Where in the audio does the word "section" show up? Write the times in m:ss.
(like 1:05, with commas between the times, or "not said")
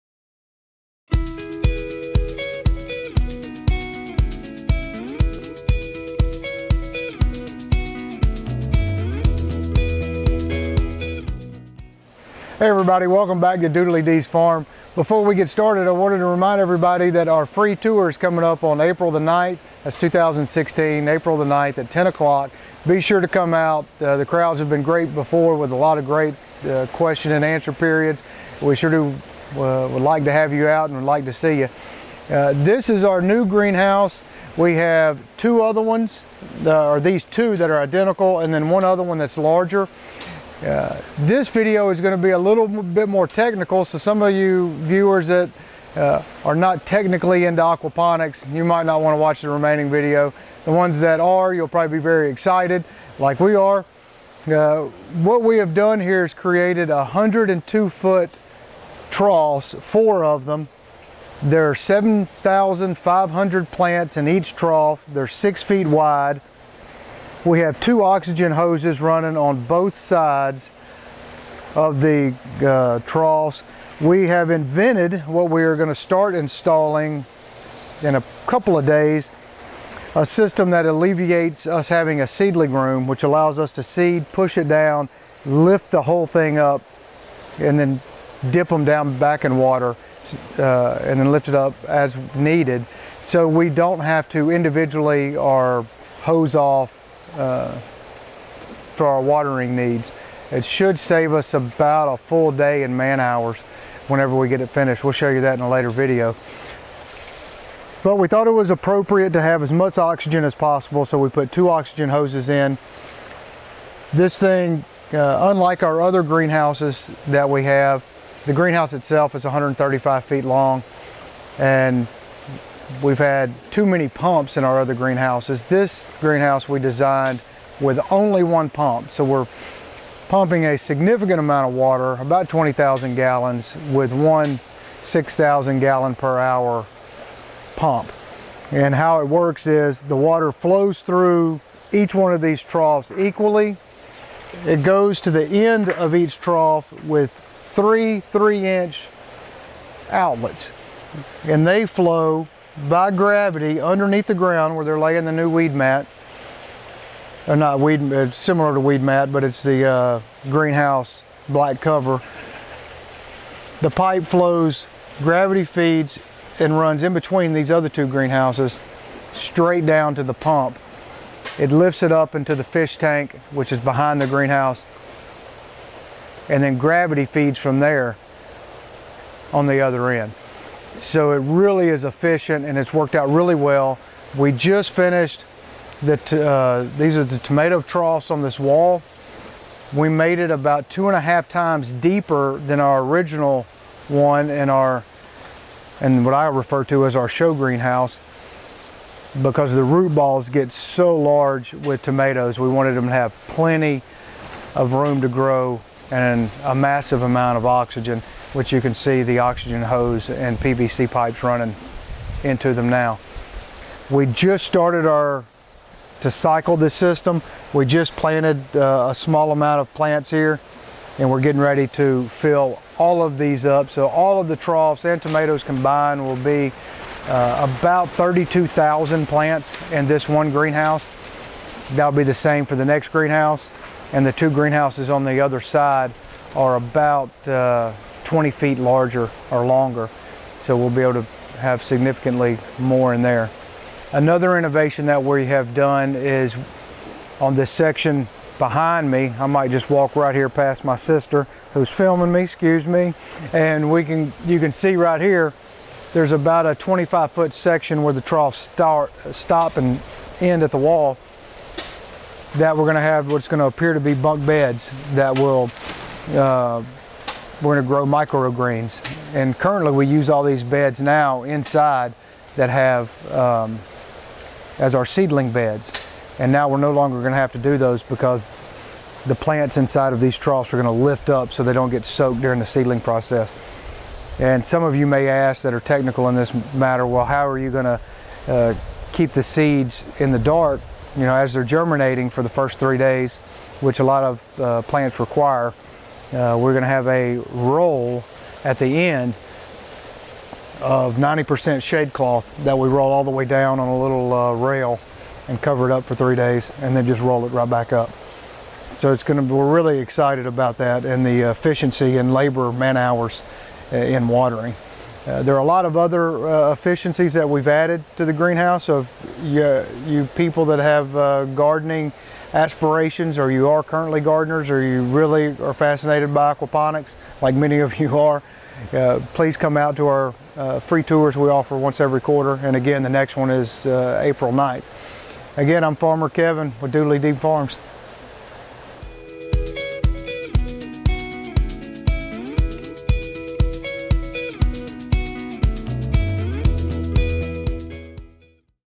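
4:07, 4:17.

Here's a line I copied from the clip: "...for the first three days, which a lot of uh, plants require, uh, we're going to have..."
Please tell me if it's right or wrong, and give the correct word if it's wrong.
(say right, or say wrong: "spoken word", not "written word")
right.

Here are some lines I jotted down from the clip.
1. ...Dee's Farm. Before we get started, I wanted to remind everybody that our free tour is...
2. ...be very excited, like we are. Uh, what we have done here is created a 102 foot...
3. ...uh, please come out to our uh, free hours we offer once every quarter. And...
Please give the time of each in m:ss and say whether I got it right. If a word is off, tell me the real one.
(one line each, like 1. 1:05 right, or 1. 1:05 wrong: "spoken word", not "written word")
1. 0:14 right
2. 0:51 right
3. 5:28 wrong: "tours", not "hours".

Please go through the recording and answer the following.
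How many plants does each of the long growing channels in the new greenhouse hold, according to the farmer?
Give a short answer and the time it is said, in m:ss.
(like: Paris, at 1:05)
7,500, at 1:01.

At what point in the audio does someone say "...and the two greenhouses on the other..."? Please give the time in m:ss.
3:54.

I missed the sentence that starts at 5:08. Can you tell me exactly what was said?
So it's going to, we're really excited about that and the efficiency and labor man hours uh, in watering.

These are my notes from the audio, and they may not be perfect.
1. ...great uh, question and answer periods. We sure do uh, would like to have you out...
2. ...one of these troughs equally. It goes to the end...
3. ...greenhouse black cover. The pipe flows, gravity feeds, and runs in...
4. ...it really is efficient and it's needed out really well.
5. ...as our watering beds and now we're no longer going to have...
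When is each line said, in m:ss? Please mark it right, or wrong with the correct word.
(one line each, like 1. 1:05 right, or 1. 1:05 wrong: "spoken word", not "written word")
1. 0:26 right
2. 2:22 right
3. 2:40 right
4. 3:01 wrong: "worked", not "needed"
5. 4:34 wrong: "seedling", not "watering".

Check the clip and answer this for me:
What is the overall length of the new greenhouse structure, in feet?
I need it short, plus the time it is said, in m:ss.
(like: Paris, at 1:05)
135 feet, at 1:59.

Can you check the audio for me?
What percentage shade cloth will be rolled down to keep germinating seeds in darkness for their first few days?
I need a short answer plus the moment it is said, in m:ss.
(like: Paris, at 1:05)
90%, at 5:01.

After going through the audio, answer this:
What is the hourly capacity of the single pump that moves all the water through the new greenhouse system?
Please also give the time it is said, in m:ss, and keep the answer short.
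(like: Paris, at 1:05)
6,000 gallons per hour, at 2:15.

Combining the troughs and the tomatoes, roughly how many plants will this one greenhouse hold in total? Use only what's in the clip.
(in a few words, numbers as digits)
32,000.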